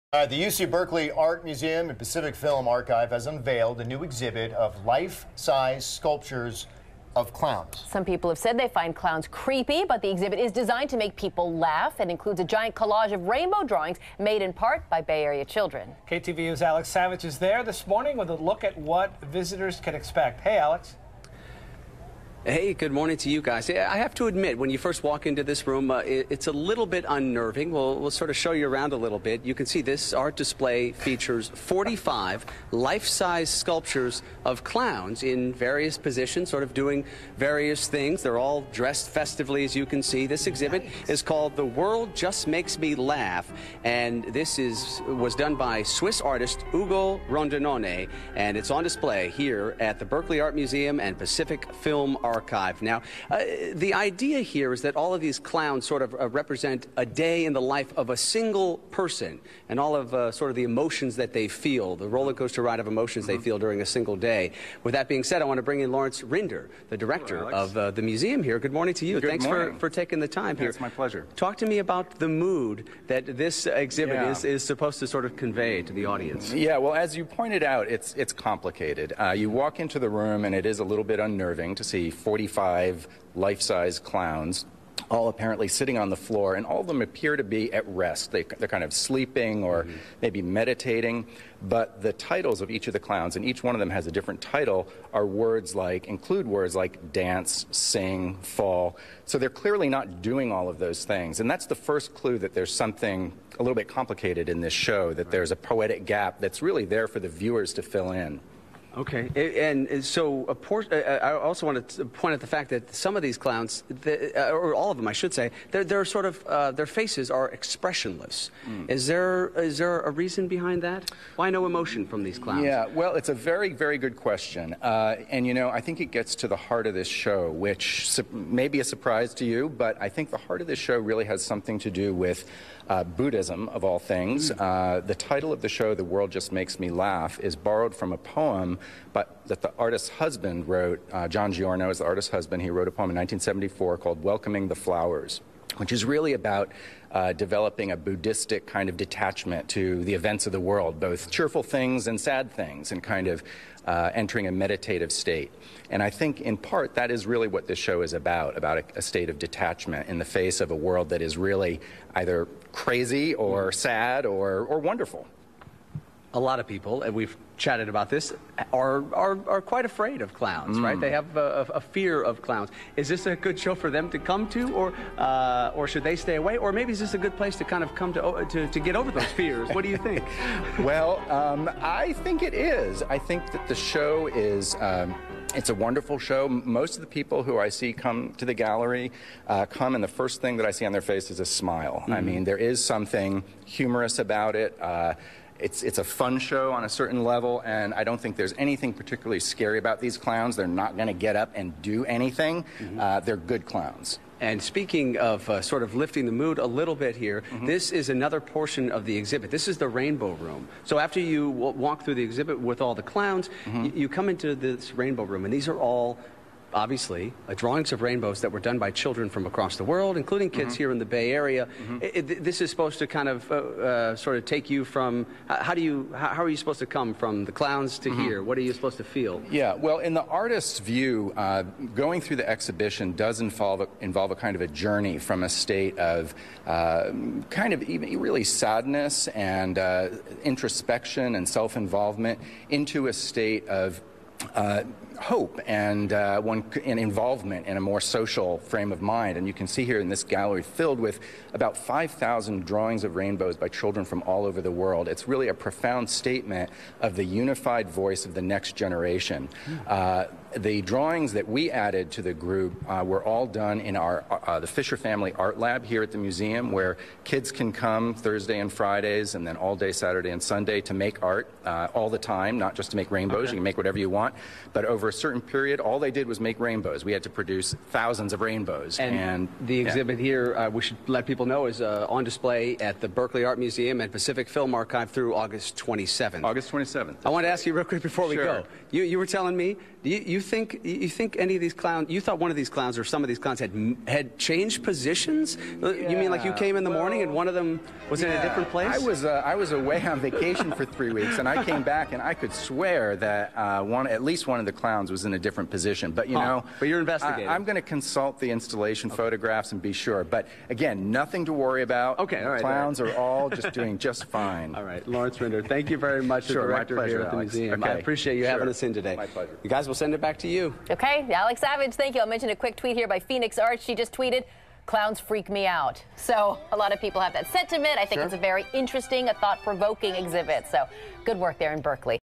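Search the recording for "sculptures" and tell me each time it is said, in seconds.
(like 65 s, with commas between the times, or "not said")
5 s, 33 s.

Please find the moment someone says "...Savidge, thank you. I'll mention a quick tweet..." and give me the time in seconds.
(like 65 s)
321 s.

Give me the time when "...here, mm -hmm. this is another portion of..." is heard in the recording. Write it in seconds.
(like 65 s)
207 s.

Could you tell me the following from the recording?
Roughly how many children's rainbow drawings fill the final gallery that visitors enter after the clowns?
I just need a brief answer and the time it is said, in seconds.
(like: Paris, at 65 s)
5,000, at 251 s.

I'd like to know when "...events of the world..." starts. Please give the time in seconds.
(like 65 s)
150 s.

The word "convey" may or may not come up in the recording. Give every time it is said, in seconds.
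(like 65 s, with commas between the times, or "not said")
75 s.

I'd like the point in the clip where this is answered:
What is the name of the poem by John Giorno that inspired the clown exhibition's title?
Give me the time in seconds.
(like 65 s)
144 s.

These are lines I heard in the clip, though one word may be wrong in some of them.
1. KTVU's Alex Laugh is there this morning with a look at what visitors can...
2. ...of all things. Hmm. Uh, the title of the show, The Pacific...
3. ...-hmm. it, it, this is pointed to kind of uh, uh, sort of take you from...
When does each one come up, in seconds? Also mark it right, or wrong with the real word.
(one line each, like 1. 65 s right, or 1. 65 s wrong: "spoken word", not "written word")
1. 16 s wrong: "Savidge", not "Laugh"
2. 133 s wrong: "World", not "Pacific"
3. 221 s wrong: "supposed", not "pointed".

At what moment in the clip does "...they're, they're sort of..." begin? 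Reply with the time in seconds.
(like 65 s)
115 s.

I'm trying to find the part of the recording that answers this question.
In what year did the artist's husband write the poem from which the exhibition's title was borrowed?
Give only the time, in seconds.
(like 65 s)
143 s.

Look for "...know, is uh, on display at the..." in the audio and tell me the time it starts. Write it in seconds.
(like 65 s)
281 s.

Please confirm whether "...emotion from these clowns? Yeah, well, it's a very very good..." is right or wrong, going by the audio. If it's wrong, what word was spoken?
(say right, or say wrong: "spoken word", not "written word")
right.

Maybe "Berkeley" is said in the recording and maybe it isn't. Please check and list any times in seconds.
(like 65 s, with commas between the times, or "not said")
0 s, 50 s, 283 s, 331 s.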